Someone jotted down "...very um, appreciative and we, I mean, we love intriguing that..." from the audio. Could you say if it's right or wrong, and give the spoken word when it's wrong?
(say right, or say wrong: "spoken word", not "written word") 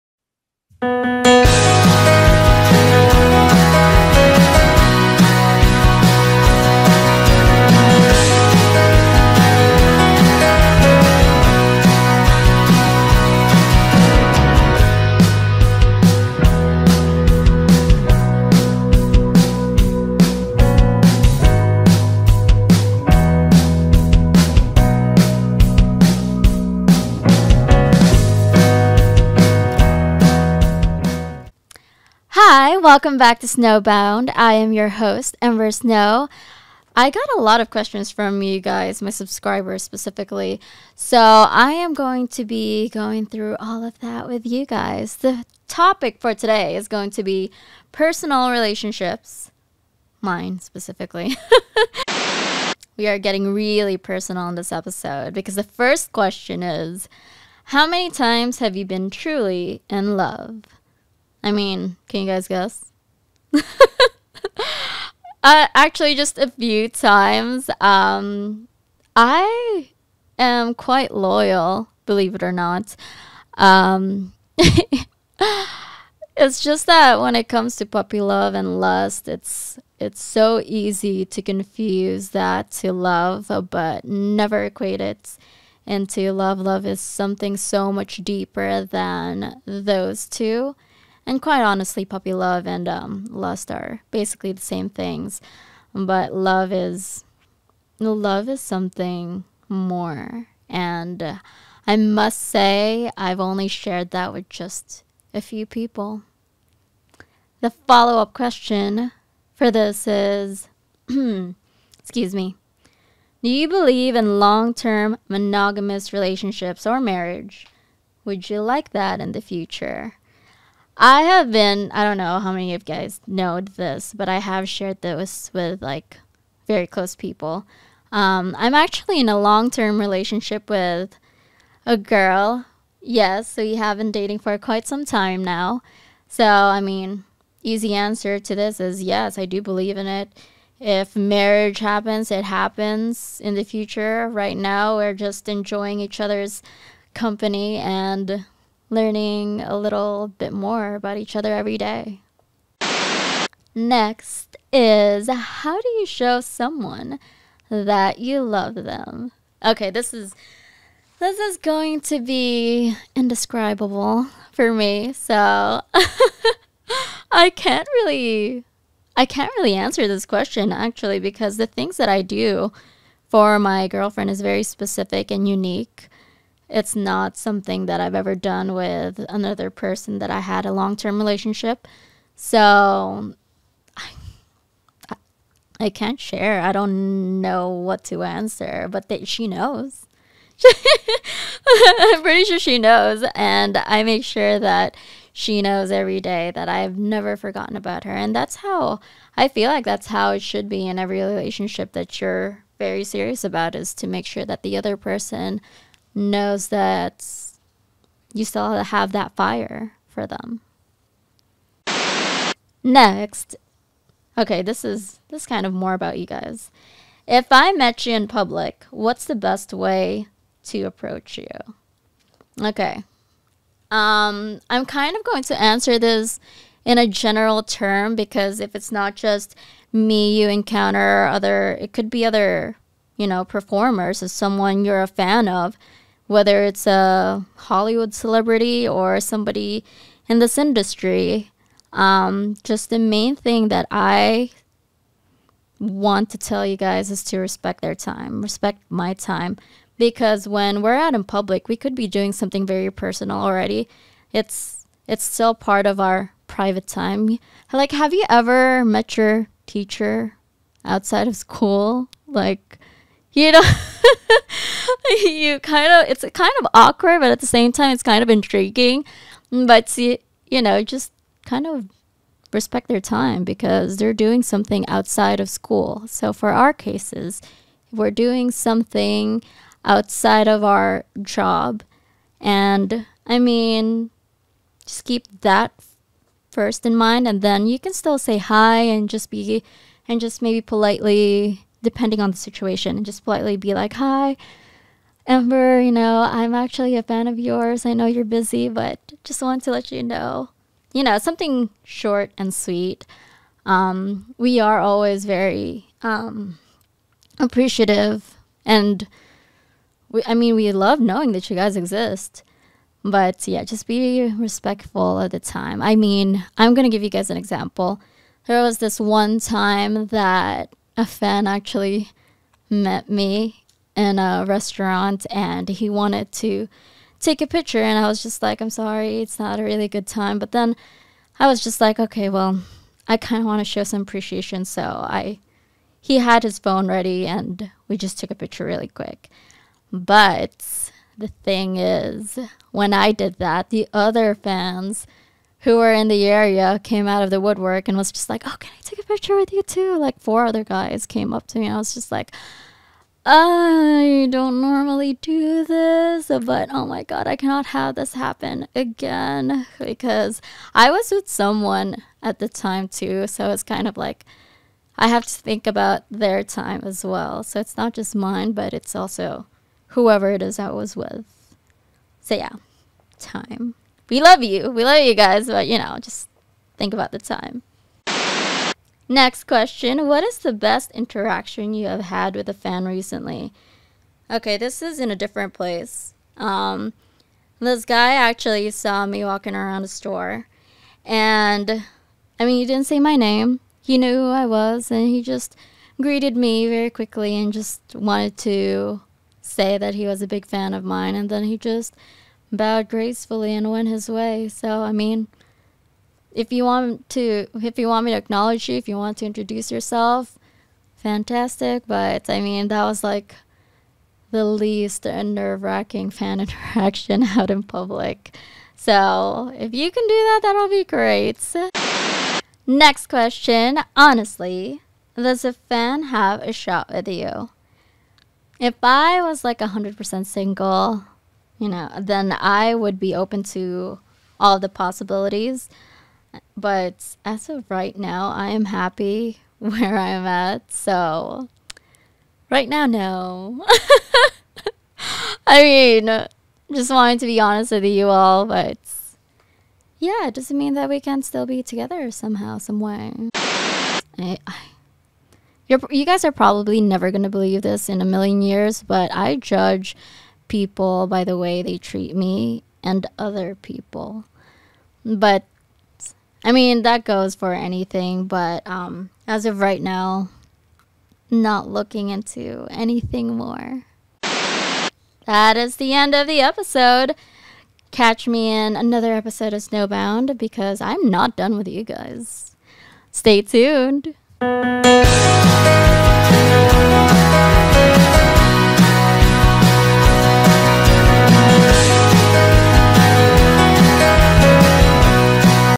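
wrong: "knowing", not "intriguing".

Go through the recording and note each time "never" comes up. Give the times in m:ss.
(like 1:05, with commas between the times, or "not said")
1:24, 3:16, 7:36.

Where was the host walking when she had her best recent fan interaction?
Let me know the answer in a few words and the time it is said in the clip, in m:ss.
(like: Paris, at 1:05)
A store, at 6:29.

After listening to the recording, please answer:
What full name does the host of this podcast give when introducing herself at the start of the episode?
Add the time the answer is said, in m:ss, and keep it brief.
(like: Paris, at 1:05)
Ember Snow, at 0:35.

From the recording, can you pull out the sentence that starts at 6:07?
So it's not just mine, but it's also whoever it is I was with.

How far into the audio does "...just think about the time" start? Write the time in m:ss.
6:16.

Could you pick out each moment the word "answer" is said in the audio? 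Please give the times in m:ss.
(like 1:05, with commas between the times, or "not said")
2:17, 2:49, 3:08, 3:45.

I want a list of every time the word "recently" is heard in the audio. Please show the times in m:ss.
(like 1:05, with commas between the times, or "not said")
6:22.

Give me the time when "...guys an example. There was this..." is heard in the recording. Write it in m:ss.
5:17.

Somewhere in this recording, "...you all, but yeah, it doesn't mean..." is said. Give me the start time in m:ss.
7:27.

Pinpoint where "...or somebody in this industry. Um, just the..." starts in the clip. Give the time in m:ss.
3:58.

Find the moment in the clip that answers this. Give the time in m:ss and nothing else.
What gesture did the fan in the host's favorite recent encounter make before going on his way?
6:42.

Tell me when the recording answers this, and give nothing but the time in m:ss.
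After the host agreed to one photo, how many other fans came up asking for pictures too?
5:50.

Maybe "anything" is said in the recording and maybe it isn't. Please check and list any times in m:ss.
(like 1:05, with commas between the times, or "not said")
7:47, 7:52.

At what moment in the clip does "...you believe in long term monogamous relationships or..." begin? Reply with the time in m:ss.
1:53.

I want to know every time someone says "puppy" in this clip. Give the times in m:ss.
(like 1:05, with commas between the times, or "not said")
1:17, 1:32.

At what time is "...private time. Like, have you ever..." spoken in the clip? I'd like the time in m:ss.
4:16.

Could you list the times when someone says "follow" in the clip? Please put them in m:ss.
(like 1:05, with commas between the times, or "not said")
1:47.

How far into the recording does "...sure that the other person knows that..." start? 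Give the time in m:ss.
3:24.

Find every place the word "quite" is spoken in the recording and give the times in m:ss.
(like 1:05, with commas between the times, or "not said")
1:10, 1:31, 2:14.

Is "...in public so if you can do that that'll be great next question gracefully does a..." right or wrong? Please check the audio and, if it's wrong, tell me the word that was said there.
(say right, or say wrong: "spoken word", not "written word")
wrong: "honestly", not "gracefully".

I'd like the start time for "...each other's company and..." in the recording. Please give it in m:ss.
2:25.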